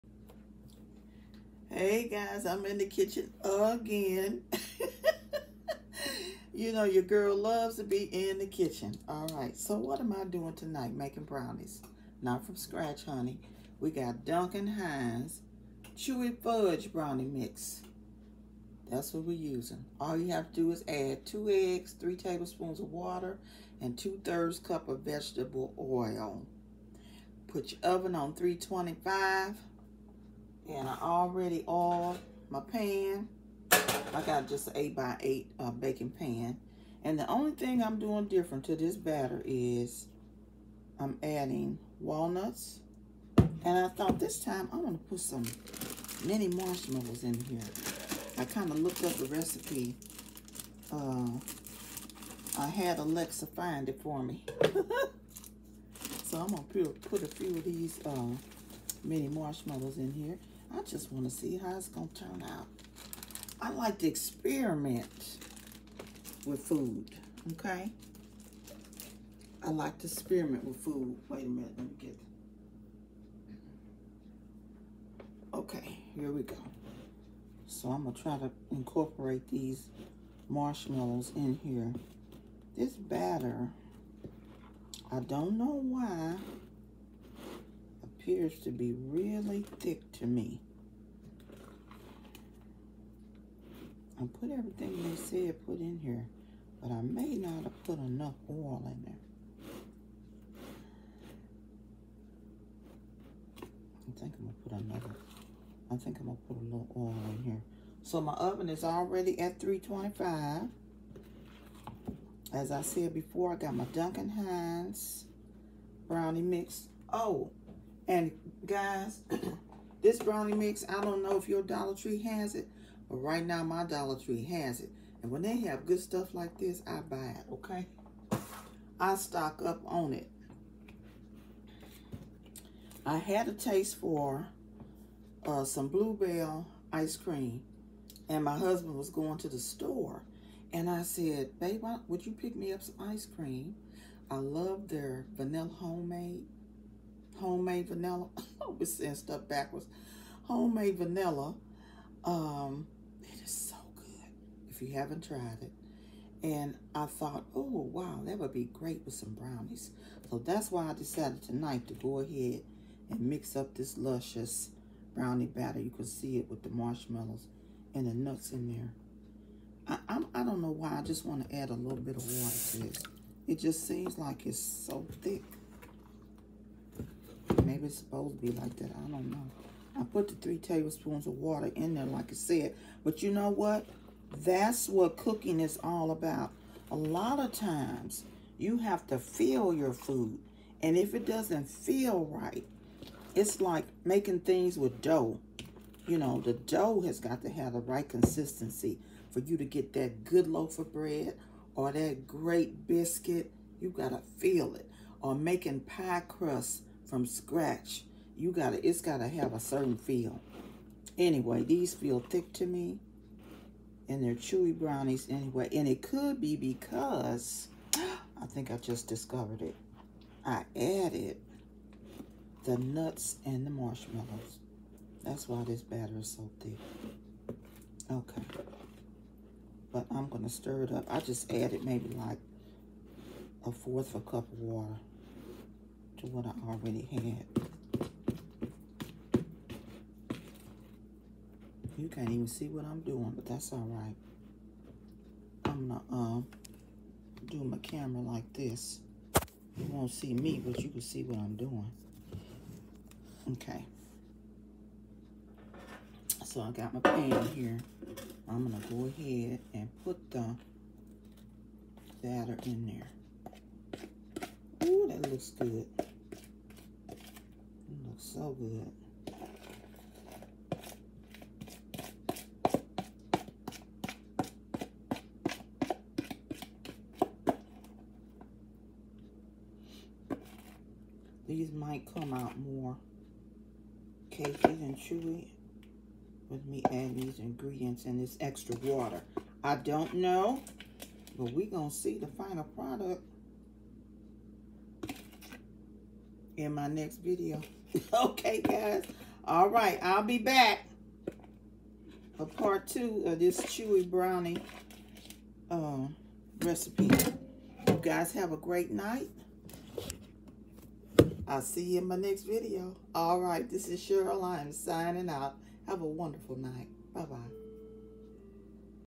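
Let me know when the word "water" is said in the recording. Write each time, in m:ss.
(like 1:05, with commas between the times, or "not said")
0:22, 2:52, 3:01, 3:54, 4:48.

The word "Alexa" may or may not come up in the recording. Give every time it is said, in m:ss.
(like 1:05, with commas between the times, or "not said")
0:52.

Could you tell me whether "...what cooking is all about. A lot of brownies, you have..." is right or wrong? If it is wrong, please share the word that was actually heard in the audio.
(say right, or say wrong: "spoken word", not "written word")
wrong: "times", not "brownies".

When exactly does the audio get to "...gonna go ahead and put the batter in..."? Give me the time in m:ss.
4:18.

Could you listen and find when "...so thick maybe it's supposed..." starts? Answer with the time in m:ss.
2:54.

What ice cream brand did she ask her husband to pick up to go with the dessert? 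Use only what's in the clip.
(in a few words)
Bluebell.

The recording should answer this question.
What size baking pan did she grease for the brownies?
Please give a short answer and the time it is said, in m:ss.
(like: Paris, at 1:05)
8 by 8, at 0:34.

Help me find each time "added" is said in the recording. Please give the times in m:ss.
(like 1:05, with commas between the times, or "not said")
3:40, 3:51.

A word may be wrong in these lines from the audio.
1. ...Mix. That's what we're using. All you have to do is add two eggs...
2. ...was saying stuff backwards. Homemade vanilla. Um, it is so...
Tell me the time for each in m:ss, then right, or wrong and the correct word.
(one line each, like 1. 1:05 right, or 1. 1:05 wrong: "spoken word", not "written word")
1. 0:17 right
2. 2:28 right.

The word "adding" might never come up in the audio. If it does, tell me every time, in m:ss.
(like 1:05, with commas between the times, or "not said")
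0:41, 4:46.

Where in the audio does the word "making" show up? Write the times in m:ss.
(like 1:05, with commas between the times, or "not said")
0:10, 3:14, 3:25.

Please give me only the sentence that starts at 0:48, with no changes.
I kind of looked up the recipe.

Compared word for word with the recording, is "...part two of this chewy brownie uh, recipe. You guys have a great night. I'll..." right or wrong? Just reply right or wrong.
right.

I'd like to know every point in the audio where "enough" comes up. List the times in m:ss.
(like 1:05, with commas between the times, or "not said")
1:37.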